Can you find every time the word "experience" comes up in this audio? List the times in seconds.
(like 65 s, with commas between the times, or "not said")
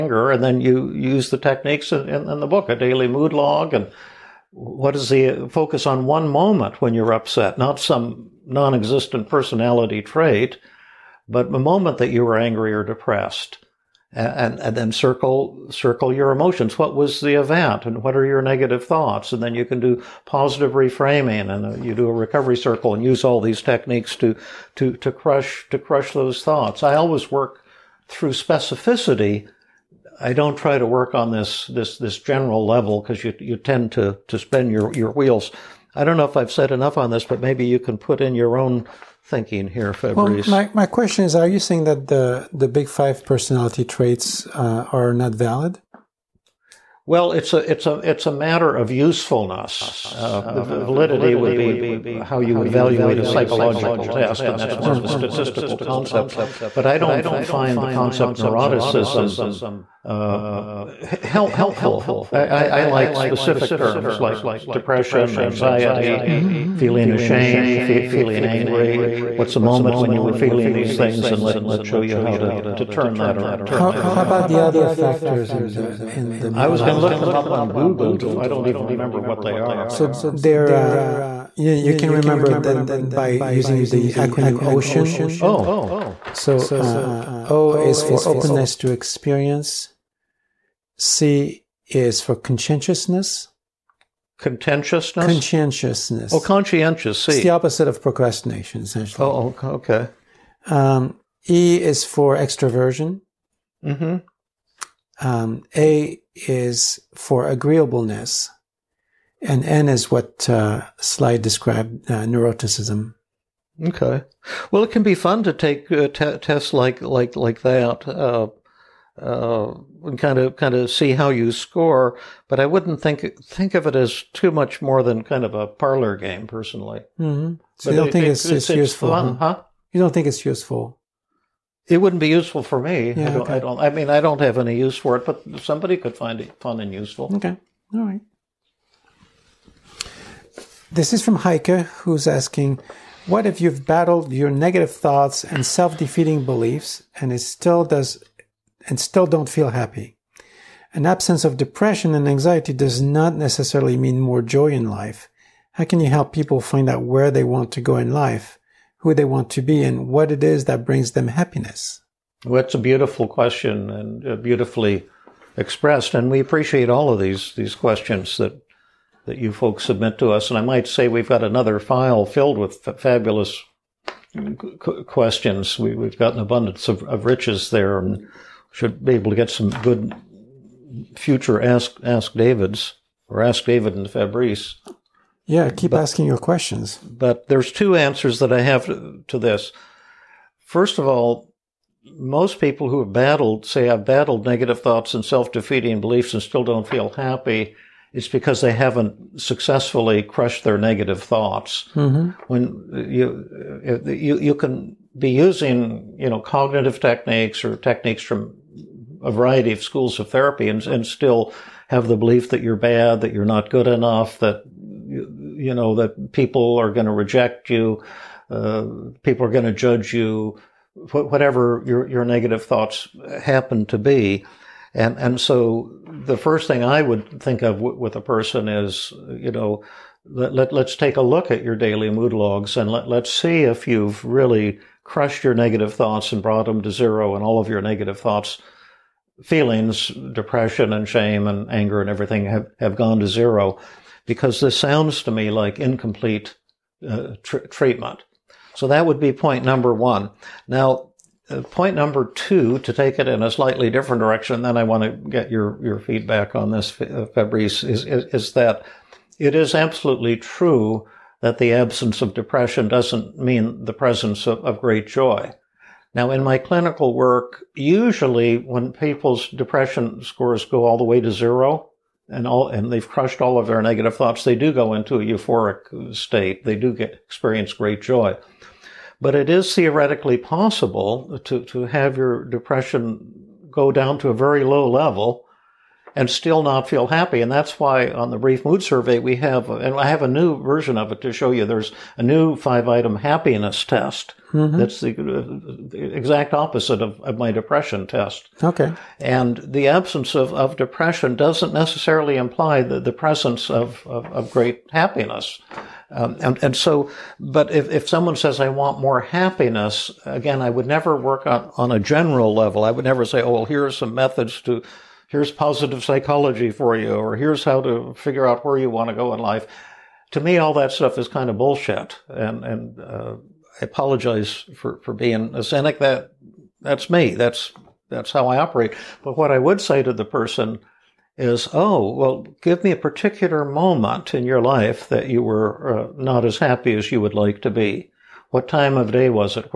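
88 s, 277 s.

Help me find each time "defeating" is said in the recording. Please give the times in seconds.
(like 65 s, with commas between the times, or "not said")
145 s, 195 s.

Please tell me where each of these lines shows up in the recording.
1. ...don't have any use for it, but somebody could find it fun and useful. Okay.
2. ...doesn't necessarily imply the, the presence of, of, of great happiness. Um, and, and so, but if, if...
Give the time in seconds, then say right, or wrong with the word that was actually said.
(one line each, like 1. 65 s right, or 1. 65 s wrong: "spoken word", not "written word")
1. 134 s right
2. 301 s right.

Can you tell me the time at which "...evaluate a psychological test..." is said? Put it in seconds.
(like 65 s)
52 s.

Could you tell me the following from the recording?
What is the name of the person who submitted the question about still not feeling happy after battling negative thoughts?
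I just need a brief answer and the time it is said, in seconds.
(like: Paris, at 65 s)
Heike, at 141 s.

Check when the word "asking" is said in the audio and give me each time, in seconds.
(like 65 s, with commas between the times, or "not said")
142 s, 186 s.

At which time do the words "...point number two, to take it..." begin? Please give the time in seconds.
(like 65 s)
251 s.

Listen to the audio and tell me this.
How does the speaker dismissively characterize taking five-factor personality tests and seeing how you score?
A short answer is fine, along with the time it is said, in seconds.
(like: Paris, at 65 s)
a parlor game, at 125 s.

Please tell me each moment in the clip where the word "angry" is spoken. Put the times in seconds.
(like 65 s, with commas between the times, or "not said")
12 s, 68 s.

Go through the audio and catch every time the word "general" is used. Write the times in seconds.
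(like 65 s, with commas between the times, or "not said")
32 s, 311 s.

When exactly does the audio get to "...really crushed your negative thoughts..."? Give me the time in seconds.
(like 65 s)
234 s.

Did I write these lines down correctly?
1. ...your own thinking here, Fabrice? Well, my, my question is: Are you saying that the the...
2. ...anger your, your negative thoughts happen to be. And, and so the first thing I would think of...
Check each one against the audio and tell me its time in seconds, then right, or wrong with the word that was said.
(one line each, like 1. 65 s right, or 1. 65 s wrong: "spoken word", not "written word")
1. 38 s right
2. 221 s wrong: "whatever", not "anger".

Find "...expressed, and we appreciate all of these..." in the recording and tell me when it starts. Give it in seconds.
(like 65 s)
165 s.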